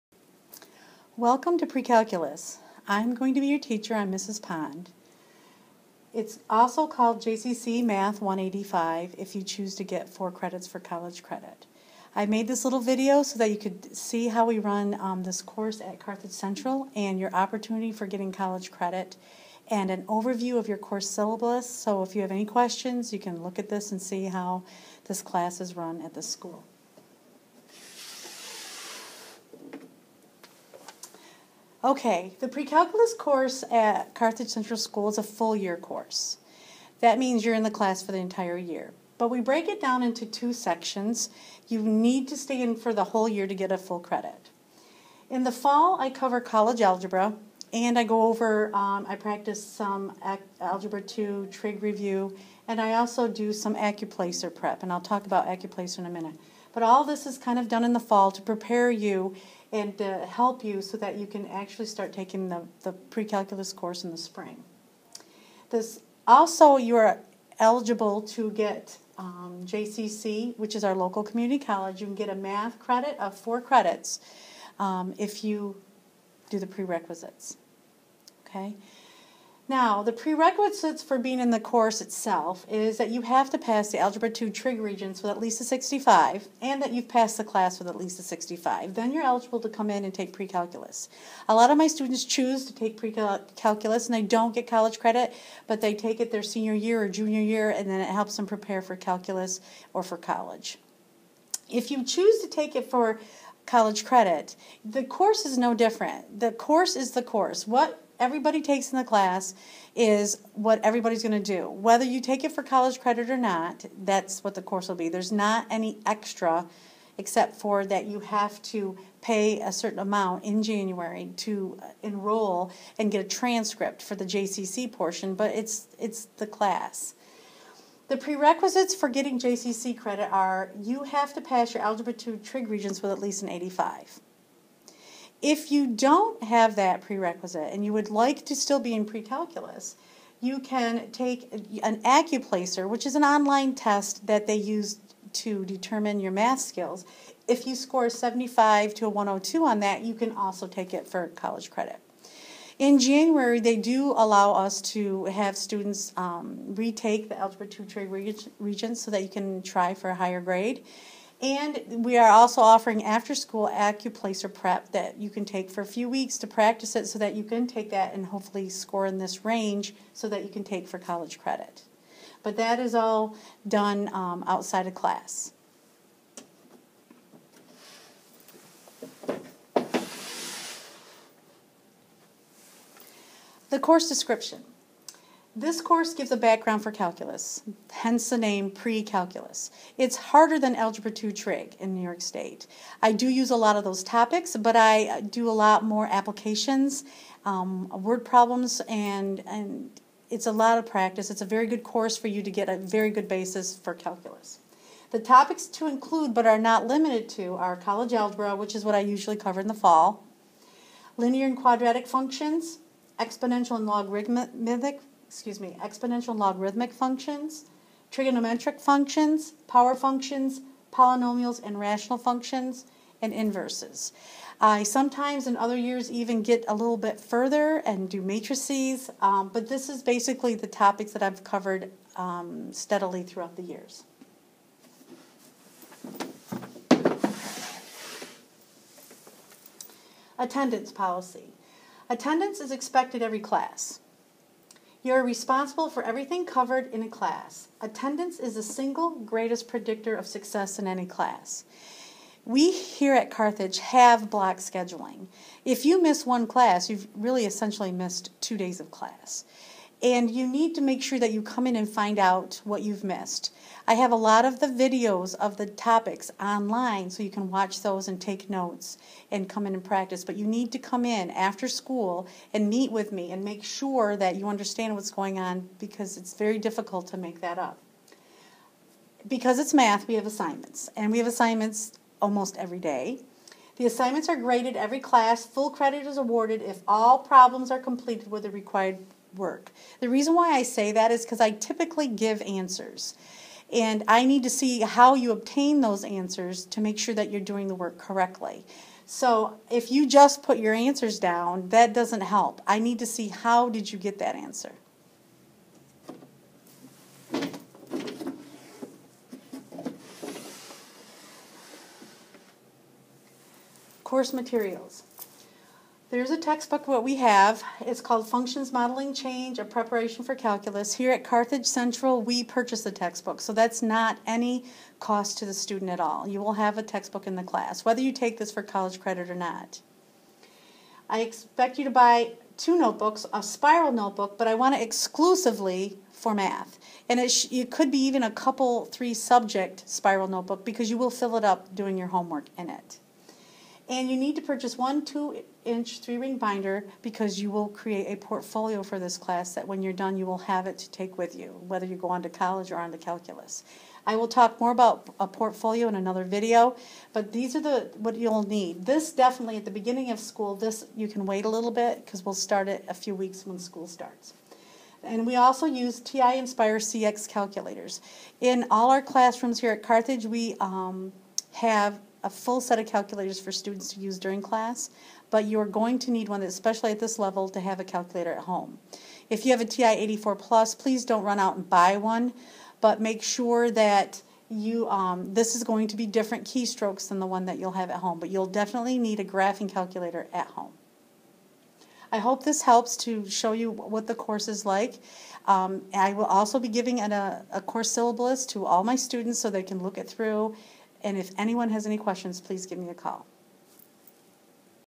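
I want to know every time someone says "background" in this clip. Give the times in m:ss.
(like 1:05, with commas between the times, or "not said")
3:06.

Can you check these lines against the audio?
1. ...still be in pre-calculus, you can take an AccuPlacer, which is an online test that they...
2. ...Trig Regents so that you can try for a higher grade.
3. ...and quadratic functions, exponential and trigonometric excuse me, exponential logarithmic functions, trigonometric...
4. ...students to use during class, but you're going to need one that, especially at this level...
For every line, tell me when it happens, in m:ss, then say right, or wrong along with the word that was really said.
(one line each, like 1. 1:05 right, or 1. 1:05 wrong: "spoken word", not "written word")
1. 2:18 right
2. 2:37 right
3. 3:31 wrong: "logarithmic", not "trigonometric"
4. 6:13 right.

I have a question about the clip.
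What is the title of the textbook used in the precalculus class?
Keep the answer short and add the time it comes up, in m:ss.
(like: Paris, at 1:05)
Functions Modeling Change, at 5:18.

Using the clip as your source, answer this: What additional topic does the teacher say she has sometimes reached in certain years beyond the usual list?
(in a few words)
matrices.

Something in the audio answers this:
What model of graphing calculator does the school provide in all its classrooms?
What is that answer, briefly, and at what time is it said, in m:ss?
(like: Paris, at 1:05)
TI Nspire CX, at 6:06.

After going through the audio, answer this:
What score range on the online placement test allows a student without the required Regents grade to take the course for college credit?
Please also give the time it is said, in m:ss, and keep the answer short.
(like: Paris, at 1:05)
75 to 102, at 2:28.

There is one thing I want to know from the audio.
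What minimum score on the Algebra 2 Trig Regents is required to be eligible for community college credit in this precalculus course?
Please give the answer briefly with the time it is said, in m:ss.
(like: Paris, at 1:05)
85, at 2:13.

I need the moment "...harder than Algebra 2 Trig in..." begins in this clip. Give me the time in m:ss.
3:10.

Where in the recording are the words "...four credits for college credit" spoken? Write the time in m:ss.
0:10.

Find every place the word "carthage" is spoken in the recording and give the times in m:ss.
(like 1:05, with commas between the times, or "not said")
0:15, 0:34, 4:13, 5:21, 6:09.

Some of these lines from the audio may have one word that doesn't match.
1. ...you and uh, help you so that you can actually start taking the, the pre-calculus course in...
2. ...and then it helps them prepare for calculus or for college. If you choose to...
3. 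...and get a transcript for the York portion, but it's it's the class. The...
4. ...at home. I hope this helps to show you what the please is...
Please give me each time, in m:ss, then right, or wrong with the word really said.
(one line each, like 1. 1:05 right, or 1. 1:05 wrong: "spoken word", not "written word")
1. 0:58 right
2. 1:37 right
3. 2:02 wrong: "JCC", not "York"
4. 6:30 wrong: "course", not "please".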